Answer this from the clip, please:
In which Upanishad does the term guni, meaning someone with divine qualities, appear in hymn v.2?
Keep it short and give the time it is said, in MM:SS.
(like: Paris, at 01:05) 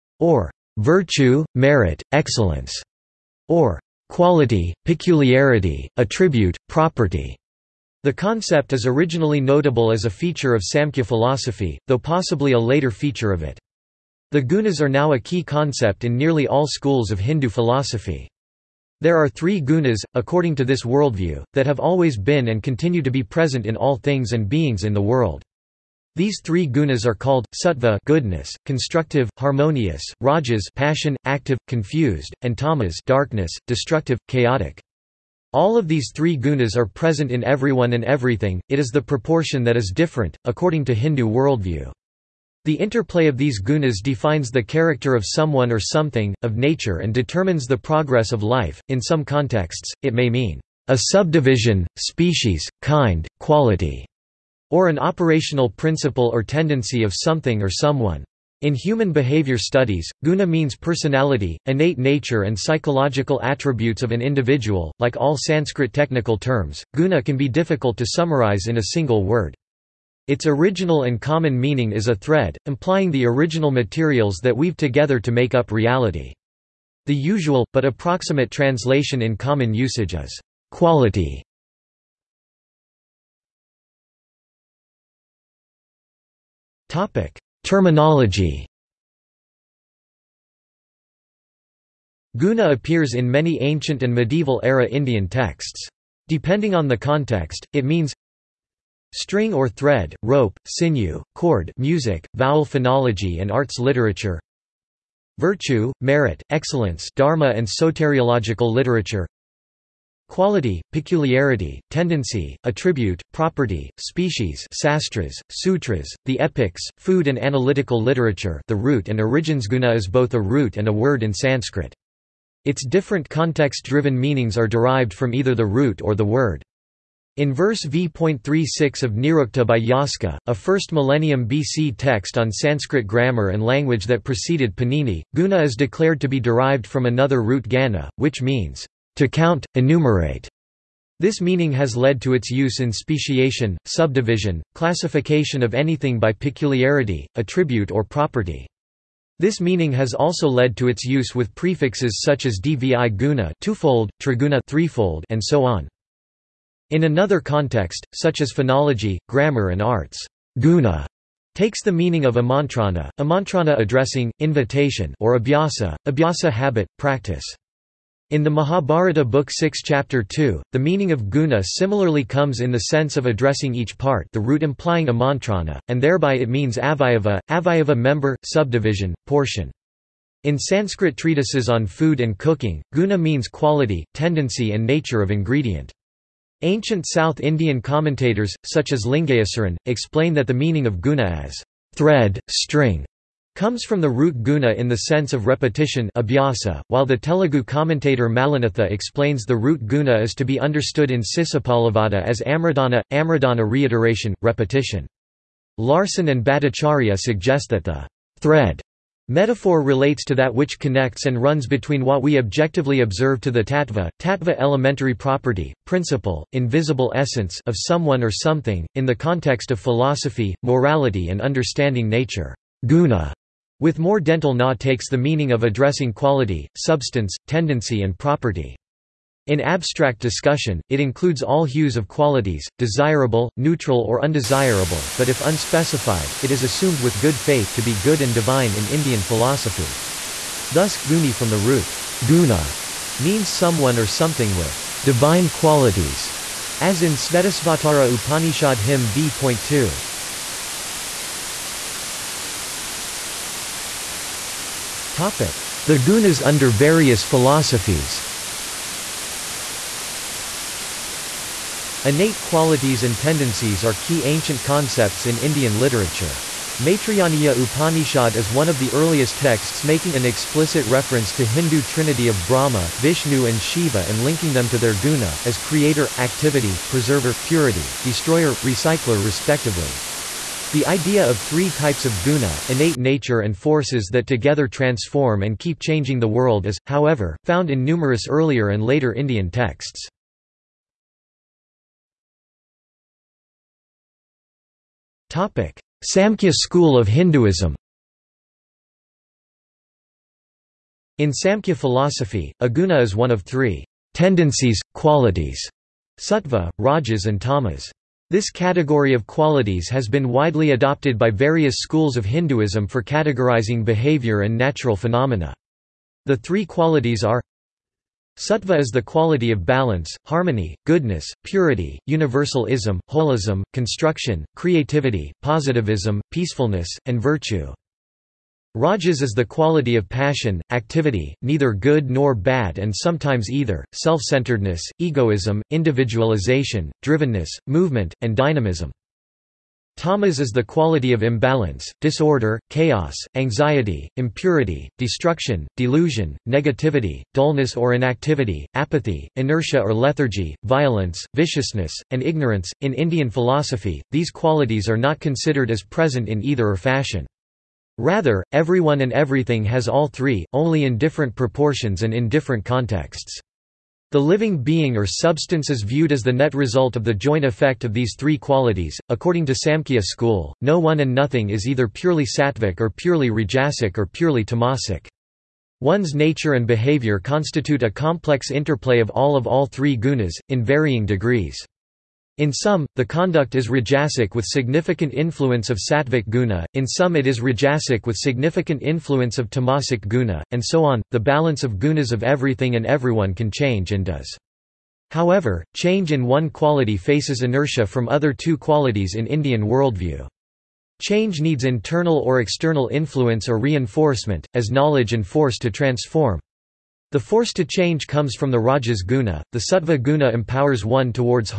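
Svetasvatara Upanishad, at 04:07.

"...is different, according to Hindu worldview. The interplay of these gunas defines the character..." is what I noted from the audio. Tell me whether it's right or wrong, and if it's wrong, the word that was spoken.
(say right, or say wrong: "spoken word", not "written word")
right.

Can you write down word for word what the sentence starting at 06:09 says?
According to Samkhya school, no one and nothing is either purely sattvic or purely rajasic or purely tamasic.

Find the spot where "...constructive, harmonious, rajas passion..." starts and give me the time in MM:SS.
00:28.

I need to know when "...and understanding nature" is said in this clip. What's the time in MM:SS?
03:41.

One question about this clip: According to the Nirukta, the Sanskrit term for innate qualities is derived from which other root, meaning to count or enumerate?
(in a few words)
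gana.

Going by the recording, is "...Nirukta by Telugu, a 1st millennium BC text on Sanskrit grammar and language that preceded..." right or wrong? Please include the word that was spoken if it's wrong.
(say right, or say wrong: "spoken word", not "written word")
wrong: "Yaska", not "Telugu".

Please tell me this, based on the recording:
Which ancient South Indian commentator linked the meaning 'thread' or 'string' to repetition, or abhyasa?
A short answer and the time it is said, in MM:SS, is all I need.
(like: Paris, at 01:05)
Lingayasaran, at 03:09.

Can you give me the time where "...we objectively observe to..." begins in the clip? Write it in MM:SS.
03:32.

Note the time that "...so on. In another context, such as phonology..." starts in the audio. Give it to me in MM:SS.
02:35.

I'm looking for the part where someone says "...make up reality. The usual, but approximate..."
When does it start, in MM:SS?
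01:15.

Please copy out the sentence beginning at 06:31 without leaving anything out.
The balance of gunas of everything and everyone can change and does.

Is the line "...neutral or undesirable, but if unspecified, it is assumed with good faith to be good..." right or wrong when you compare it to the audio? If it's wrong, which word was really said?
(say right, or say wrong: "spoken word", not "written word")
right.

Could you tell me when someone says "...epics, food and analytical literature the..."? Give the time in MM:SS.
01:56.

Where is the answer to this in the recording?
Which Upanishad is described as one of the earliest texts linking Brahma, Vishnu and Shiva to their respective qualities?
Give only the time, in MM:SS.
04:26.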